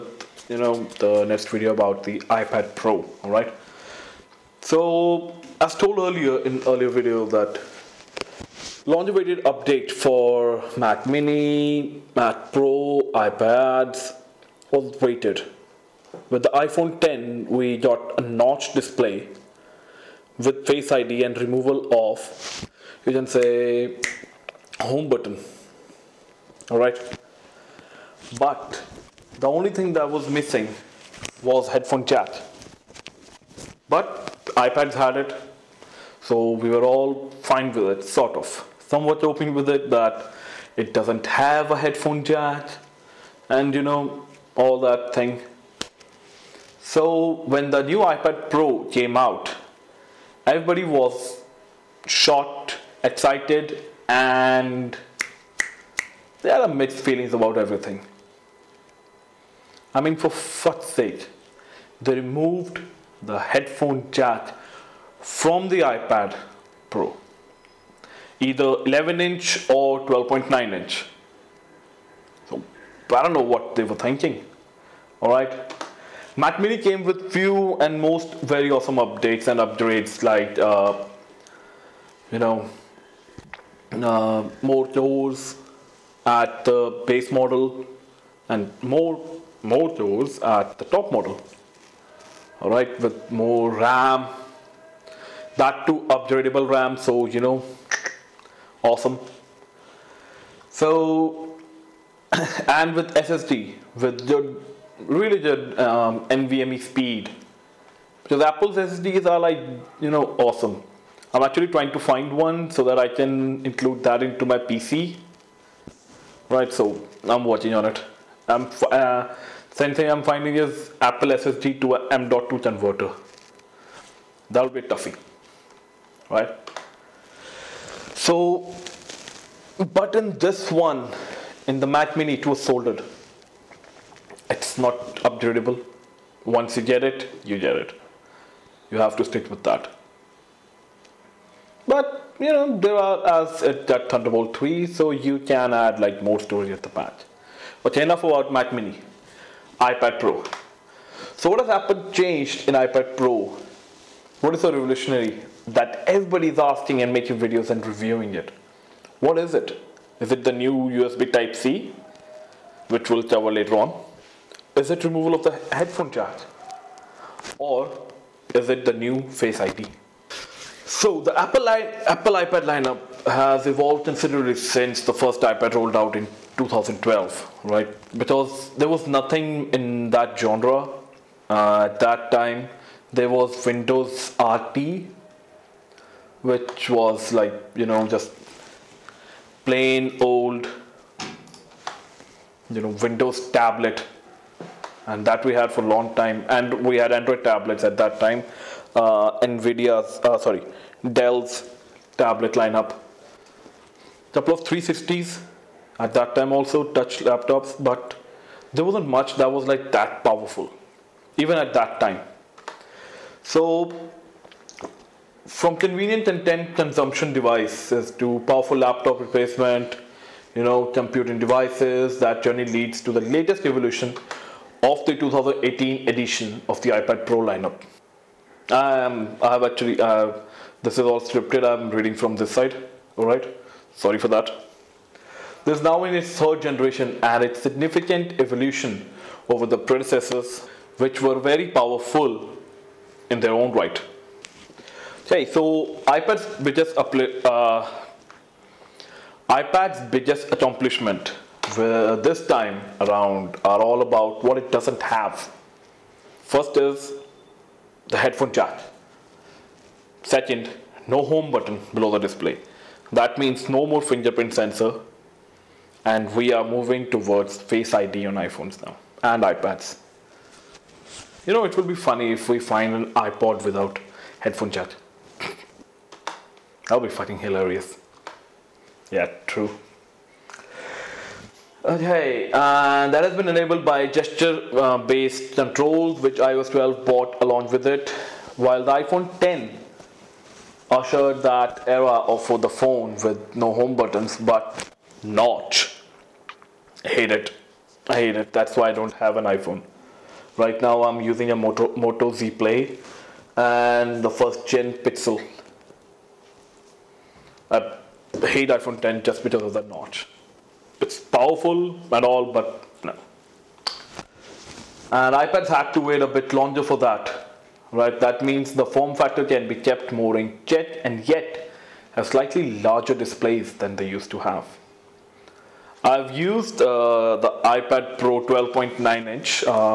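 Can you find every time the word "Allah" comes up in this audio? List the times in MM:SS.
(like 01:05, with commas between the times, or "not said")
not said.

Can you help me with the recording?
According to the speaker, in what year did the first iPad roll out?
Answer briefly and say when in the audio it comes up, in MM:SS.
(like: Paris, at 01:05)
2012, at 02:56.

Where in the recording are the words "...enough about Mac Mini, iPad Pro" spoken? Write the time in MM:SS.
02:28.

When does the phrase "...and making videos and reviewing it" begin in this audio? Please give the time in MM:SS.
02:37.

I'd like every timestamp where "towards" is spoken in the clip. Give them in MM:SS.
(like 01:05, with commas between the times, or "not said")
04:27.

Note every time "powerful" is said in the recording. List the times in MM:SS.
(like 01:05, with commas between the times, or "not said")
03:30, 03:38, 04:01, 05:11.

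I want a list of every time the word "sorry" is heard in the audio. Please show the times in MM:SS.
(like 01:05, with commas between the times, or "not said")
03:20, 03:53.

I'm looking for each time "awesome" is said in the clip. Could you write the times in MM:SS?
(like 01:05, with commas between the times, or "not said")
01:18, 01:38, 01:50.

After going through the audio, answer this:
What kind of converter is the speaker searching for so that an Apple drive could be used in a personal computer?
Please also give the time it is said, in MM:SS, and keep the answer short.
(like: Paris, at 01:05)
Apple SSD to M.2 converter, at 02:01.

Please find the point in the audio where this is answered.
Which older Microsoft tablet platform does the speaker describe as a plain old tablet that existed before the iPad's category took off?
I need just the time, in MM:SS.
03:03.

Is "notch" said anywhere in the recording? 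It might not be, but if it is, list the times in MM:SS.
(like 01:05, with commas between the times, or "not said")
00:18, 04:55, 05:09.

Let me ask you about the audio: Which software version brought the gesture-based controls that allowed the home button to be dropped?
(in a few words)
iOS 12.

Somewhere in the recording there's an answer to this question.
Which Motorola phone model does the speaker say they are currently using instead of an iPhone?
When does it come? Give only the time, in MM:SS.
05:01.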